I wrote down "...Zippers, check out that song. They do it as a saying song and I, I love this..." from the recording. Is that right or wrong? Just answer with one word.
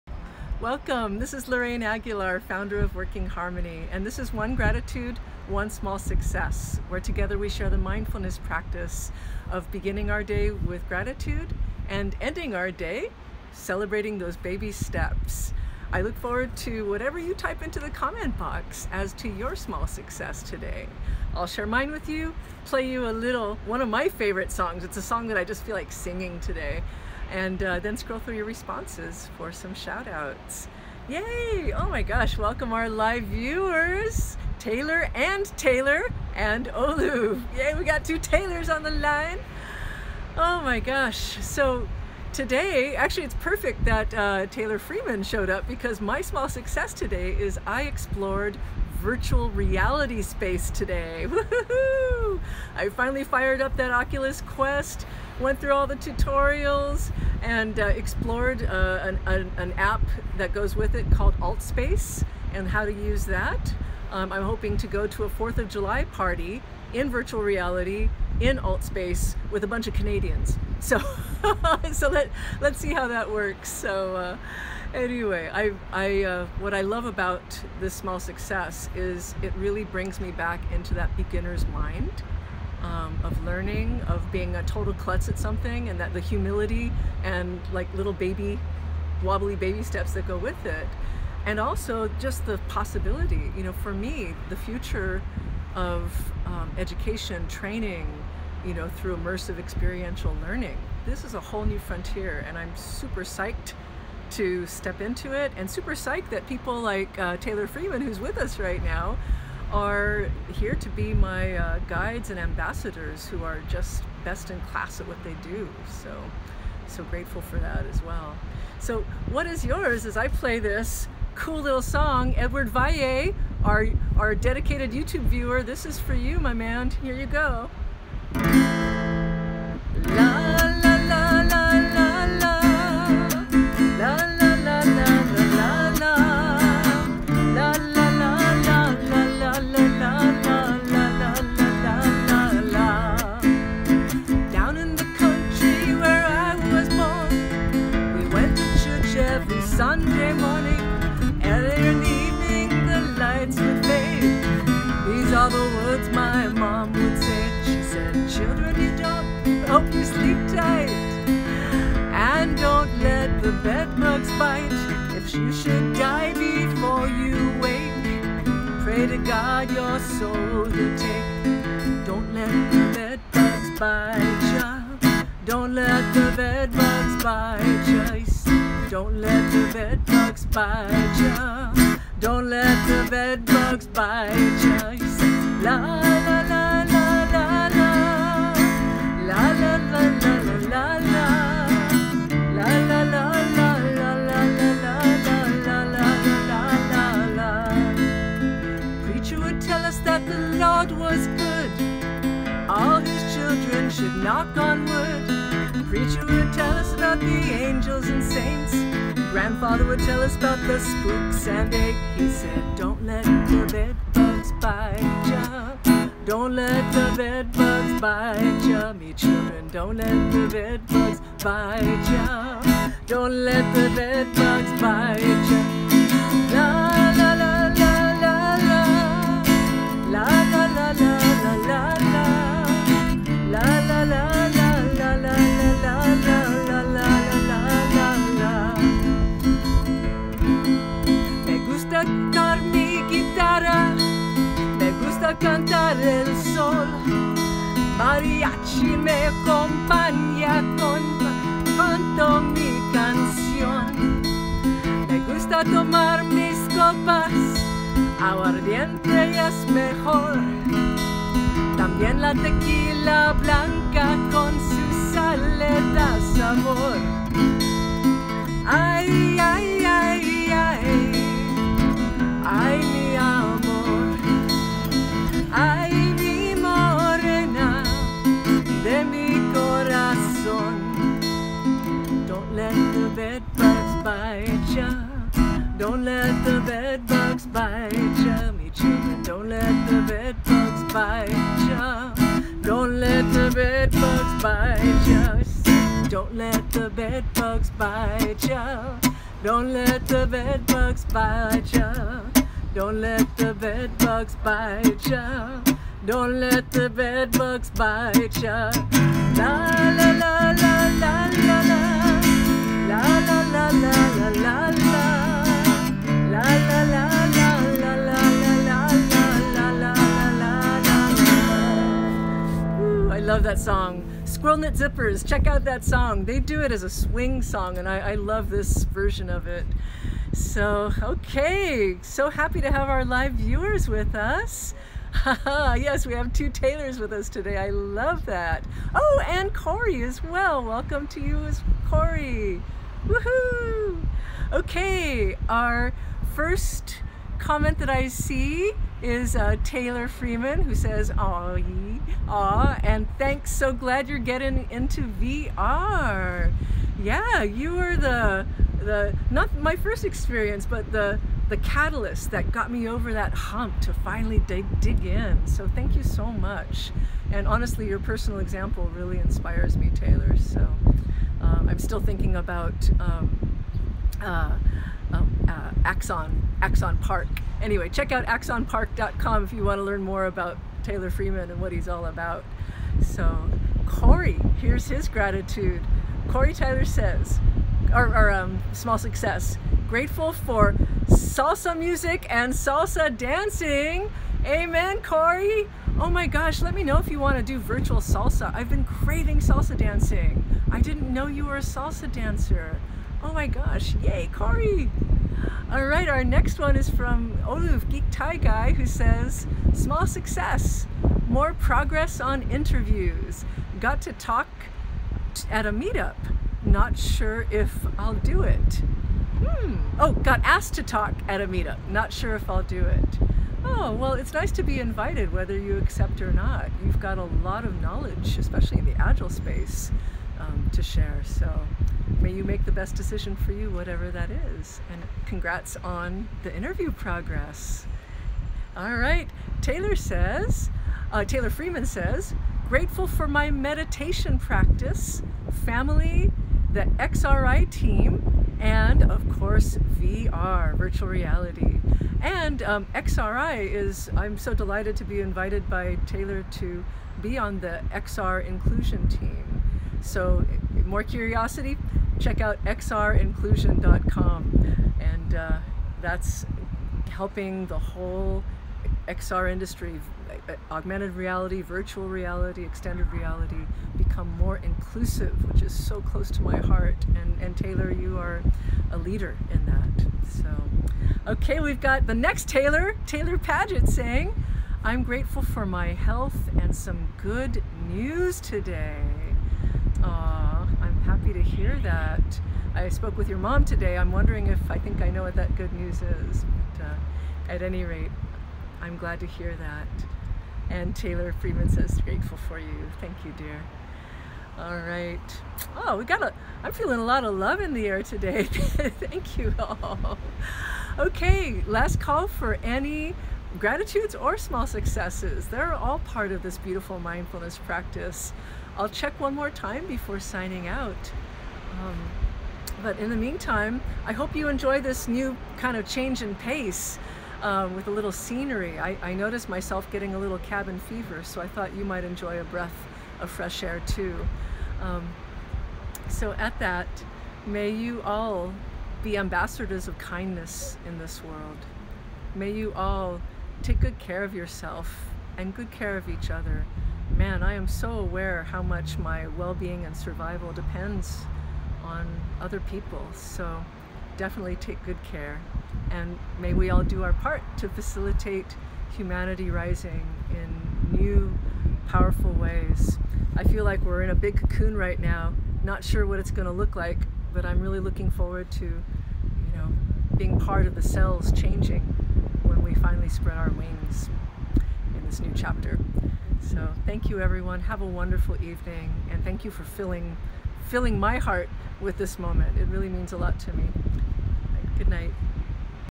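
wrong.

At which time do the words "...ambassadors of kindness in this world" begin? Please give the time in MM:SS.
08:59.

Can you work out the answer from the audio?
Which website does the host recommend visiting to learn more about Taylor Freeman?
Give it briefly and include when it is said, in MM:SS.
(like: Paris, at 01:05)
axonpark.com, at 06:18.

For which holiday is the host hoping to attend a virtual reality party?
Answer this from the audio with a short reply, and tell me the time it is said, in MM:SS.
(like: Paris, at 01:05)
4th of July, at 01:05.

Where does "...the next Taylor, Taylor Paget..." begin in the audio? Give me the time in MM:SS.
08:02.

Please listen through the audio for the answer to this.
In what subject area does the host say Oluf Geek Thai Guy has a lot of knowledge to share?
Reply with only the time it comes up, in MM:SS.
07:08.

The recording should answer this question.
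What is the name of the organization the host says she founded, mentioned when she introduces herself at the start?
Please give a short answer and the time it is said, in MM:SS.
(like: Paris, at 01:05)
Working Harmony, at 00:02.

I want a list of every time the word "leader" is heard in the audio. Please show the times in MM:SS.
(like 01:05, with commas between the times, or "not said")
07:58.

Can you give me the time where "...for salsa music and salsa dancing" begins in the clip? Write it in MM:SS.
06:30.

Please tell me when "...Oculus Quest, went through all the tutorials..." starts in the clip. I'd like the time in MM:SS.
00:53.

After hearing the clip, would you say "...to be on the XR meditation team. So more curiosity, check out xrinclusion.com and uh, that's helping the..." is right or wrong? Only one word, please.
wrong.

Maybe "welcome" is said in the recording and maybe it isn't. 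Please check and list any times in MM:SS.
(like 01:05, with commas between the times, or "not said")
00:00, 00:32, 05:40.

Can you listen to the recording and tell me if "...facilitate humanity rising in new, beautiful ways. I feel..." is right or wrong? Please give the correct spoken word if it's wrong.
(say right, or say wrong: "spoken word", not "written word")
wrong: "powerful", not "beautiful".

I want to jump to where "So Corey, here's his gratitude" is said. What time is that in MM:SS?
06:23.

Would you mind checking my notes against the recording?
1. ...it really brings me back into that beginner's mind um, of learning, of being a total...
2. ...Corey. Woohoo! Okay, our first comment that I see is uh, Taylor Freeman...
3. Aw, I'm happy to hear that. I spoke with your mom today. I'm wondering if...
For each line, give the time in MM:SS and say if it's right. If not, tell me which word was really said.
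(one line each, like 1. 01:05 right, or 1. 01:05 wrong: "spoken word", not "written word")
1. 01:19 right
2. 05:41 right
3. 08:10 right.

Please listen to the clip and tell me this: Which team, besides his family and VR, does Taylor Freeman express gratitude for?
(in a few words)
The XRI team.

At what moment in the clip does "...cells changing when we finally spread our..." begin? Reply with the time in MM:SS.
09:30.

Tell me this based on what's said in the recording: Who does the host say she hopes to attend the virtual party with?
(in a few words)
Canadians.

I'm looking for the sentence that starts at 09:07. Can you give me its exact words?
Man, I am so aware how much my well-being and survival depends on other people.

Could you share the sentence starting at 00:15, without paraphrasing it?
I look forward to whatever you type into the comment box as to your small success today.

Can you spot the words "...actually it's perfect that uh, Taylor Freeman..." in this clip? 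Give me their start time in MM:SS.
00:42.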